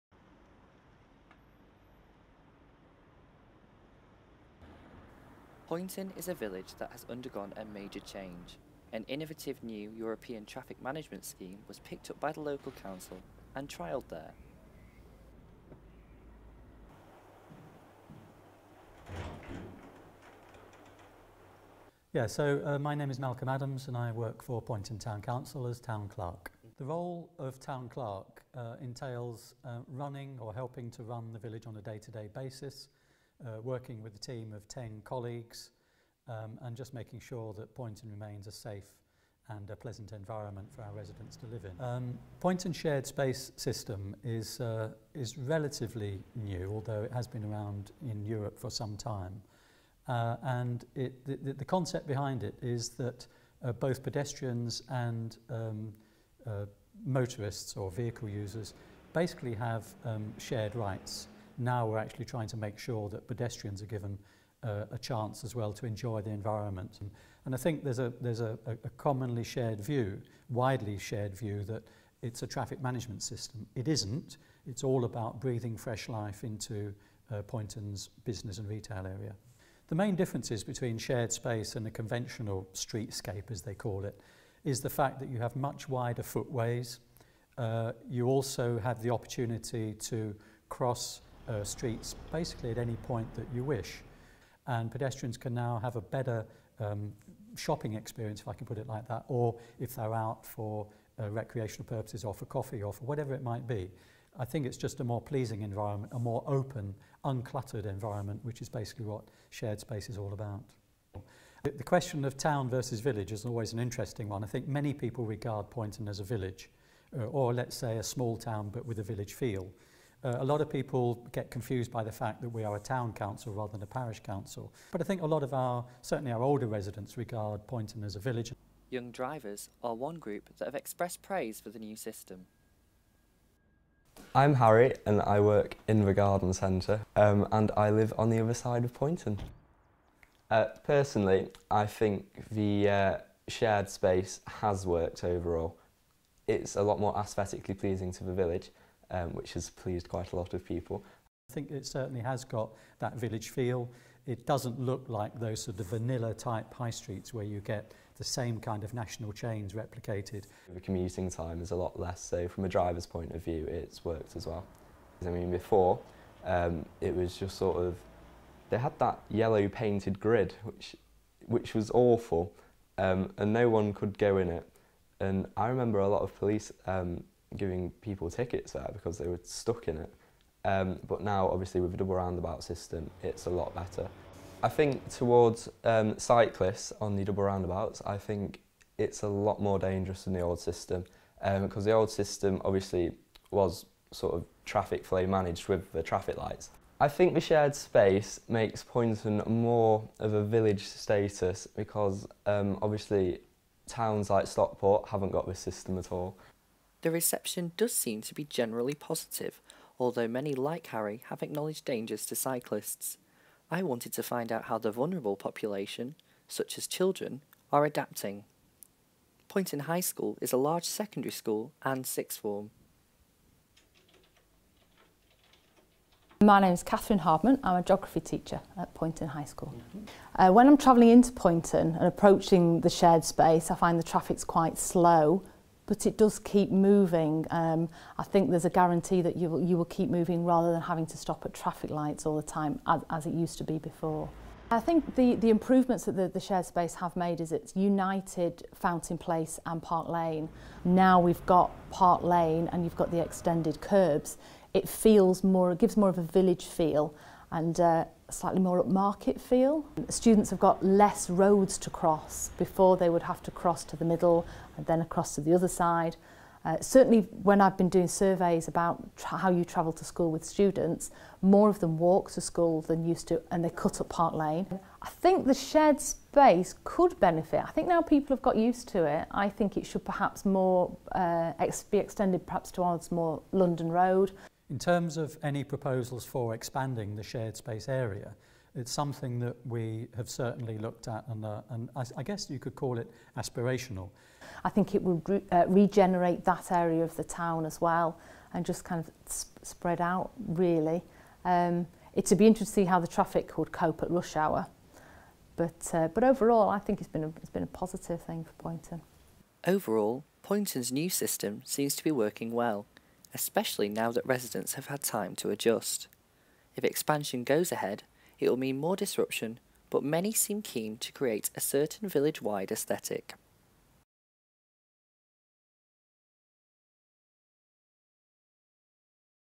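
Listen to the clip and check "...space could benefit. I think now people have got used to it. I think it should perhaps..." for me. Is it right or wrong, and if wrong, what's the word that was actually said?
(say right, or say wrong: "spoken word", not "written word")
right.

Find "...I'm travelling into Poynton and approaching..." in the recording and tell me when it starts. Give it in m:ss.
3:50.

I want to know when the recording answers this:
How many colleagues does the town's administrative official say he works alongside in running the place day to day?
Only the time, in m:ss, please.
0:34.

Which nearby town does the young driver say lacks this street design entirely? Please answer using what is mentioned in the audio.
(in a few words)
Stockport.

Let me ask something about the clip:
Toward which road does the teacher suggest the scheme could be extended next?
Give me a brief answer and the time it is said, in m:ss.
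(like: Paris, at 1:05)
London Road, at 4:43.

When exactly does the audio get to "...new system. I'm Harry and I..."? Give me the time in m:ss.
2:11.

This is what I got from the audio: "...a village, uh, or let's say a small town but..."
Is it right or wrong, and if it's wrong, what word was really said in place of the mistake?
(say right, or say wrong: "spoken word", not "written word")
right.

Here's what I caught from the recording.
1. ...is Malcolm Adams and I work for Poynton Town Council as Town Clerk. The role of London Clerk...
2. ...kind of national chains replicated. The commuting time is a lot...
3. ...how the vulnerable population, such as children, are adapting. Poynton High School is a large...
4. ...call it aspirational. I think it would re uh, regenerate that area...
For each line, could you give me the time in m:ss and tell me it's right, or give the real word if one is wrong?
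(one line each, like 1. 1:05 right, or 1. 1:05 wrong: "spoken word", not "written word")
1. 0:23 wrong: "Town", not "London"
2. 2:38 right
3. 3:34 right
4. 4:52 right.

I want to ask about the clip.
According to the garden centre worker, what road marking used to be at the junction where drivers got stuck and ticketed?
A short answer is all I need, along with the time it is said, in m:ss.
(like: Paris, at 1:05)
yellow painted grid, at 2:49.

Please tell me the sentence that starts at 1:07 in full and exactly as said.
And, and I think there's, a, there's a, a commonly shared view, widely shared view, that it's a traffic management system.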